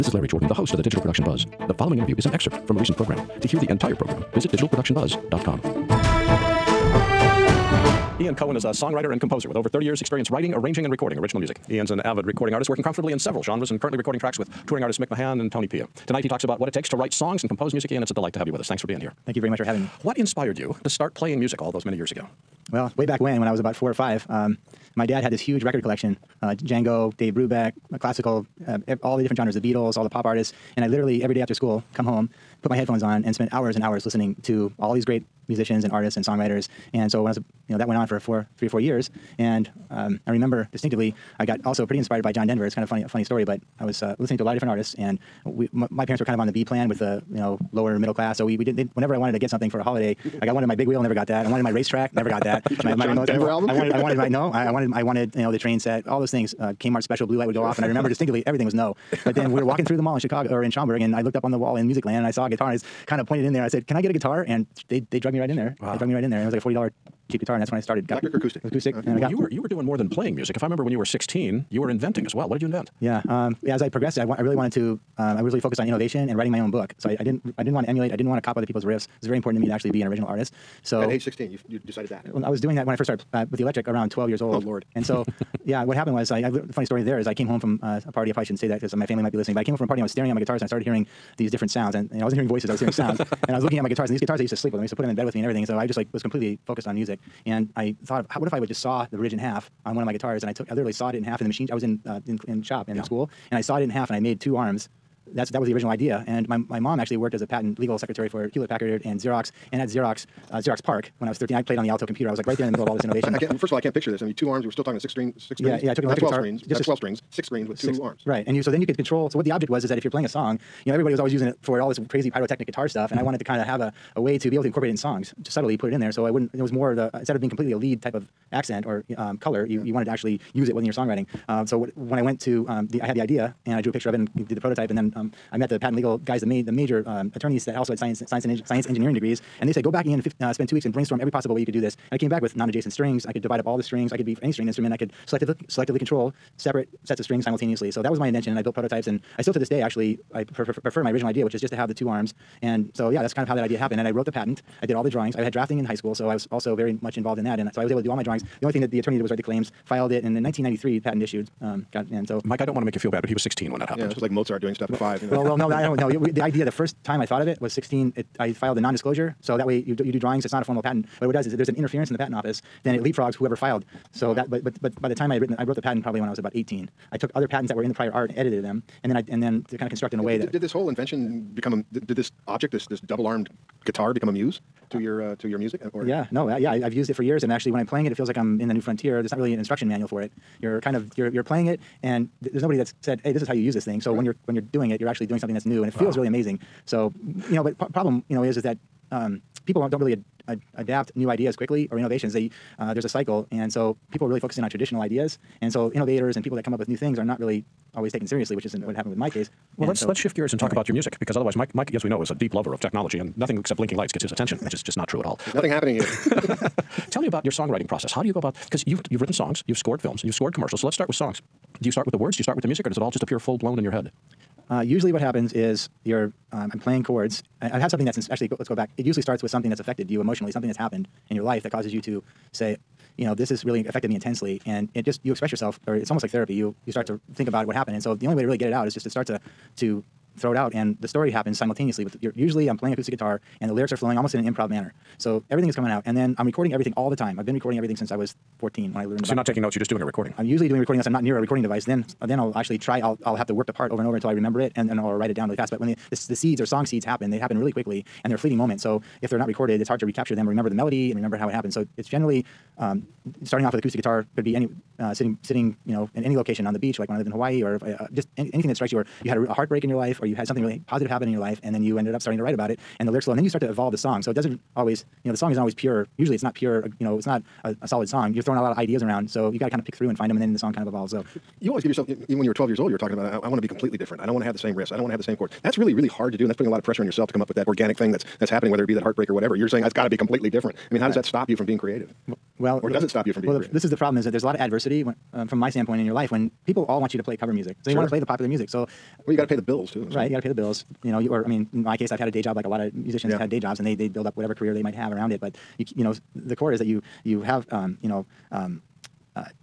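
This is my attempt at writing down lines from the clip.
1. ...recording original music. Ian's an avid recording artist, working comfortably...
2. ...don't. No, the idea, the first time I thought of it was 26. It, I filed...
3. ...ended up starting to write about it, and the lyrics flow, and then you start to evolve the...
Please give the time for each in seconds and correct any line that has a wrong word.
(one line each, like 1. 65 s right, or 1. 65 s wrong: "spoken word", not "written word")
1. 10 s right
2. 165 s wrong: "16", not "26"
3. 271 s right.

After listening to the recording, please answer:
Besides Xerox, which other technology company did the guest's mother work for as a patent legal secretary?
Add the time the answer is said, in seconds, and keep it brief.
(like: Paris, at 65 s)
Hewlett Packard, at 108 s.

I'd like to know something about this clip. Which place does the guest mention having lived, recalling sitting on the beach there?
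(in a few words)
Hawaii.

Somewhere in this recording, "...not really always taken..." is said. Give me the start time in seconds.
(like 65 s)
207 s.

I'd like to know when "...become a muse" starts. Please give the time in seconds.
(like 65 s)
184 s.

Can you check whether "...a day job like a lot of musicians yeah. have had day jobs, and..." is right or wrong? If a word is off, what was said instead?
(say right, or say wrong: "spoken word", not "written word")
right.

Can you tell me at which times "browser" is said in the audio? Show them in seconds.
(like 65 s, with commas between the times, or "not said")
not said.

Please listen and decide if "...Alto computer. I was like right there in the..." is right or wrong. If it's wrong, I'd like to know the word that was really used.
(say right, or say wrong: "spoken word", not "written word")
right.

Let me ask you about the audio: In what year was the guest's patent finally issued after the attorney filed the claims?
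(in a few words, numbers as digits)
1993.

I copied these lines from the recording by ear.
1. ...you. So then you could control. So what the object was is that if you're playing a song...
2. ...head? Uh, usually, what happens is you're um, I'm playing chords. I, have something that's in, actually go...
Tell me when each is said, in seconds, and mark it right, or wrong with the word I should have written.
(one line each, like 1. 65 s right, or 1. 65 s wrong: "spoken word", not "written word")
1. 118 s right
2. 223 s right.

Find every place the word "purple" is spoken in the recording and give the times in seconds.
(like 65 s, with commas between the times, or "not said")
not said.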